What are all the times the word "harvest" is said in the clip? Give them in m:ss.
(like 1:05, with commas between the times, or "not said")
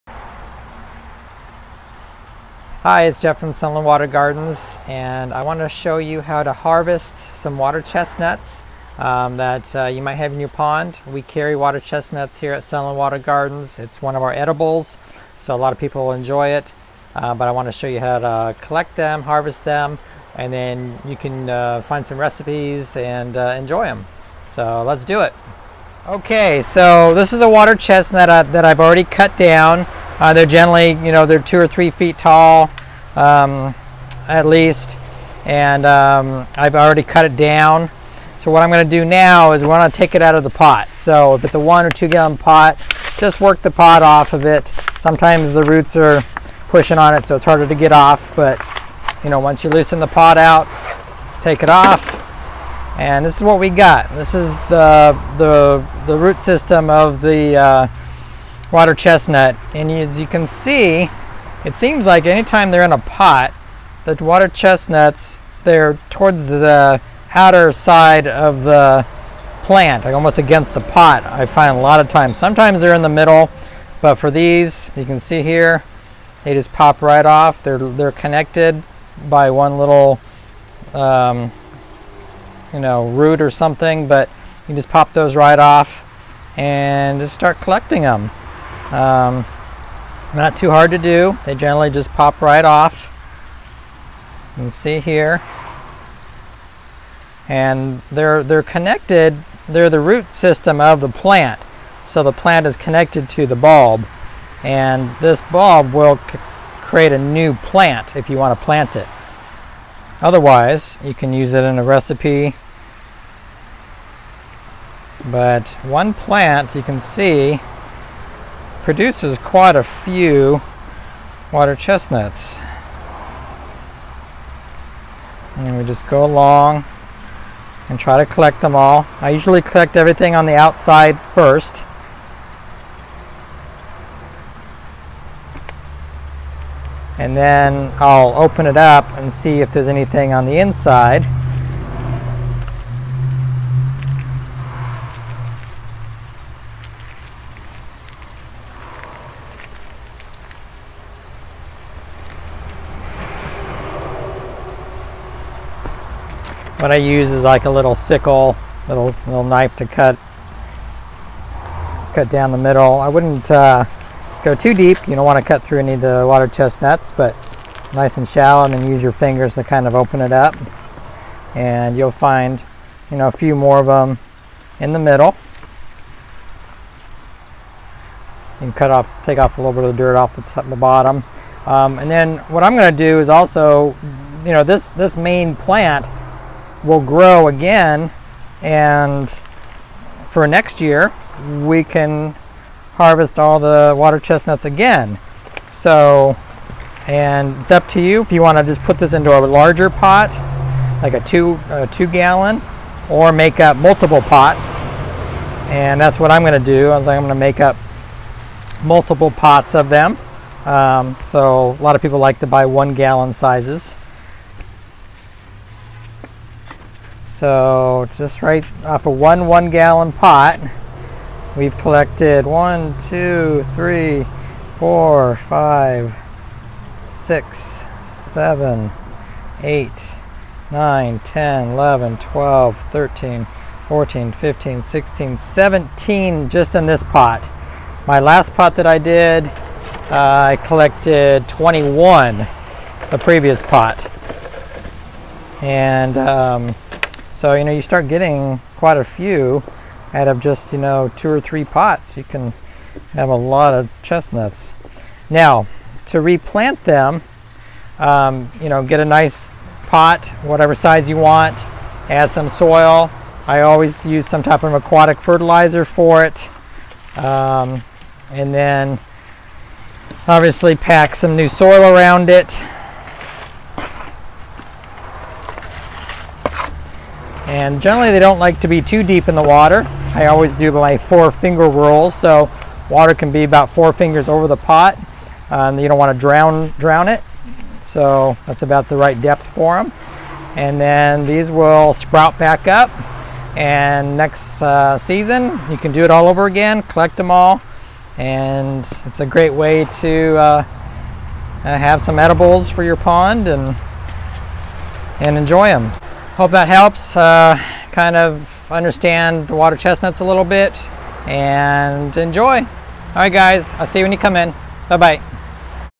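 0:06, 0:19, 3:12.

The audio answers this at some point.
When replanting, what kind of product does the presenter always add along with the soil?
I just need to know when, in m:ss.
4:24.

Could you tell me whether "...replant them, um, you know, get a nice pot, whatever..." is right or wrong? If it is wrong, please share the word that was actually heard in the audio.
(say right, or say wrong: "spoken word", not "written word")
right.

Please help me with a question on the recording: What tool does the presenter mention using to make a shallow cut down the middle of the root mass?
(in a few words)
little sickle.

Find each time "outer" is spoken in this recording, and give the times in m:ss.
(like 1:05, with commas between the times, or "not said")
1:07.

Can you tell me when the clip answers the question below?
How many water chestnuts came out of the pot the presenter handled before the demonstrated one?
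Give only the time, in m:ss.
4:01.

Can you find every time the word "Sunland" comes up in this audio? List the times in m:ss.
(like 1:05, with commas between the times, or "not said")
0:03, 0:12.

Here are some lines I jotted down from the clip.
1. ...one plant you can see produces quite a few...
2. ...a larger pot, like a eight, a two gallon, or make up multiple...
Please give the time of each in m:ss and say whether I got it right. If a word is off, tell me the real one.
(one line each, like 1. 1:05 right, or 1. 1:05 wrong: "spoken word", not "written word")
1. 1:55 right
2. 3:19 wrong: "two", not "eight".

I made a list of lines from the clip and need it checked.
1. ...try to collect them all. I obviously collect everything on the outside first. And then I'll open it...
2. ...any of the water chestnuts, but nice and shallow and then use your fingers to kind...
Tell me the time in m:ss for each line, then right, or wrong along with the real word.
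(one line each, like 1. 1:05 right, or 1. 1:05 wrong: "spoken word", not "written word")
1. 2:07 wrong: "usually", not "obviously"
2. 2:45 right.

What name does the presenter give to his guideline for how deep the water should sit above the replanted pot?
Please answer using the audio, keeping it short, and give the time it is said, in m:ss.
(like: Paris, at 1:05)
four finger rule, at 4:40.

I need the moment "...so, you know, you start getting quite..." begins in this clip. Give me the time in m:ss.
4:07.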